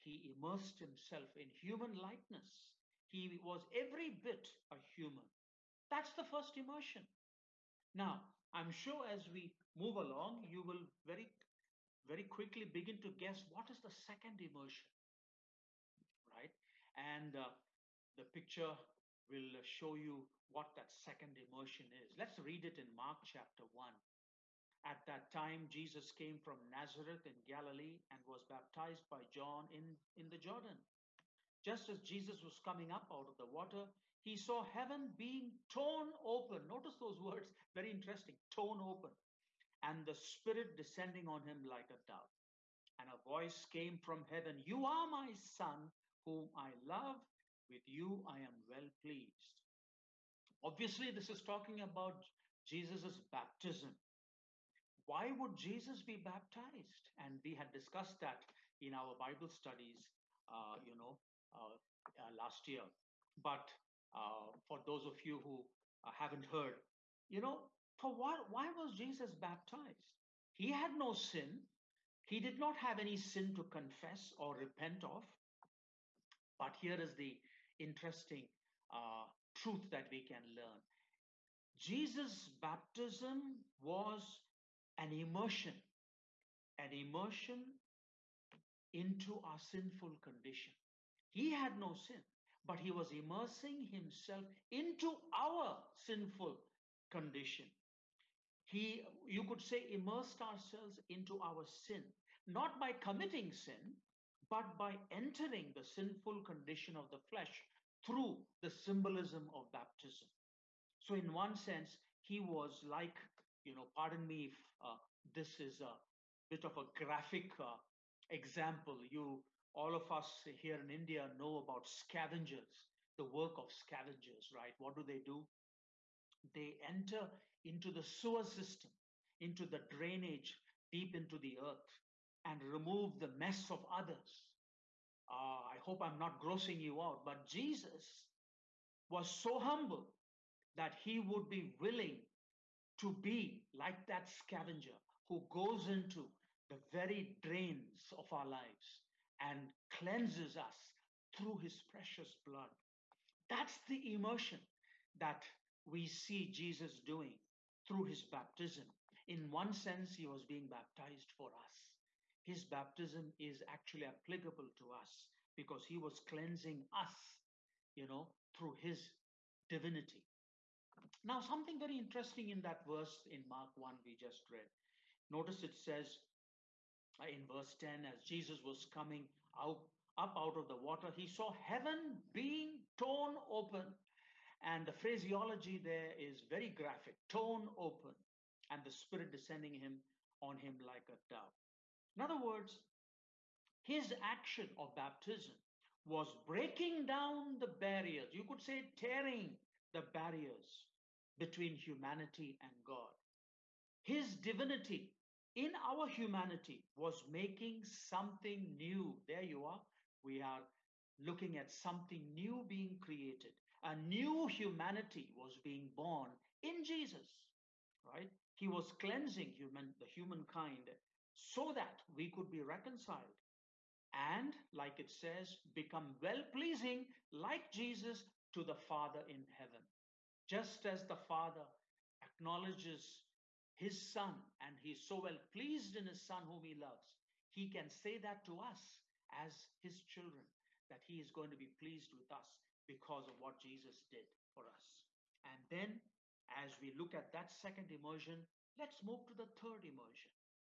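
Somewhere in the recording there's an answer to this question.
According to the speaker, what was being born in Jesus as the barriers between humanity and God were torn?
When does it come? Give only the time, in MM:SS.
03:33.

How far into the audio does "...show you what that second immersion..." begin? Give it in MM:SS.
00:19.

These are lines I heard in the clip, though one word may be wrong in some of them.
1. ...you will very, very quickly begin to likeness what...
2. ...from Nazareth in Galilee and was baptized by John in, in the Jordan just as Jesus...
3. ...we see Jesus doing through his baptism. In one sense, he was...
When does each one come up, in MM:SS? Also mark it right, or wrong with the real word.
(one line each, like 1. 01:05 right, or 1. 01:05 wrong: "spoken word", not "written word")
1. 00:10 wrong: "guess", not "likeness"
2. 00:26 right
3. 02:35 right.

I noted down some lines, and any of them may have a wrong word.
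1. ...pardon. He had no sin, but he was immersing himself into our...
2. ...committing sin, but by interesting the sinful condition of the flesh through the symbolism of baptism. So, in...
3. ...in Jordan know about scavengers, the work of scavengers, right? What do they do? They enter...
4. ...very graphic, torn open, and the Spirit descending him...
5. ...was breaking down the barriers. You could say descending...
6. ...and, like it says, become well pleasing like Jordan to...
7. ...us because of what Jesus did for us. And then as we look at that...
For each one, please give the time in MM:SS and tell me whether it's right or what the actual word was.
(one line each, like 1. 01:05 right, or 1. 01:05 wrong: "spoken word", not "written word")
1. 01:30 wrong: "condition", not "pardon"
2. 01:42 wrong: "entering", not "interesting"
3. 02:00 wrong: "India", not "Jordan"
4. 03:06 right
5. 03:16 wrong: "tearing", not "descending"
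6. 03:44 wrong: "Jesus", not "Jordan"
7. 04:02 right.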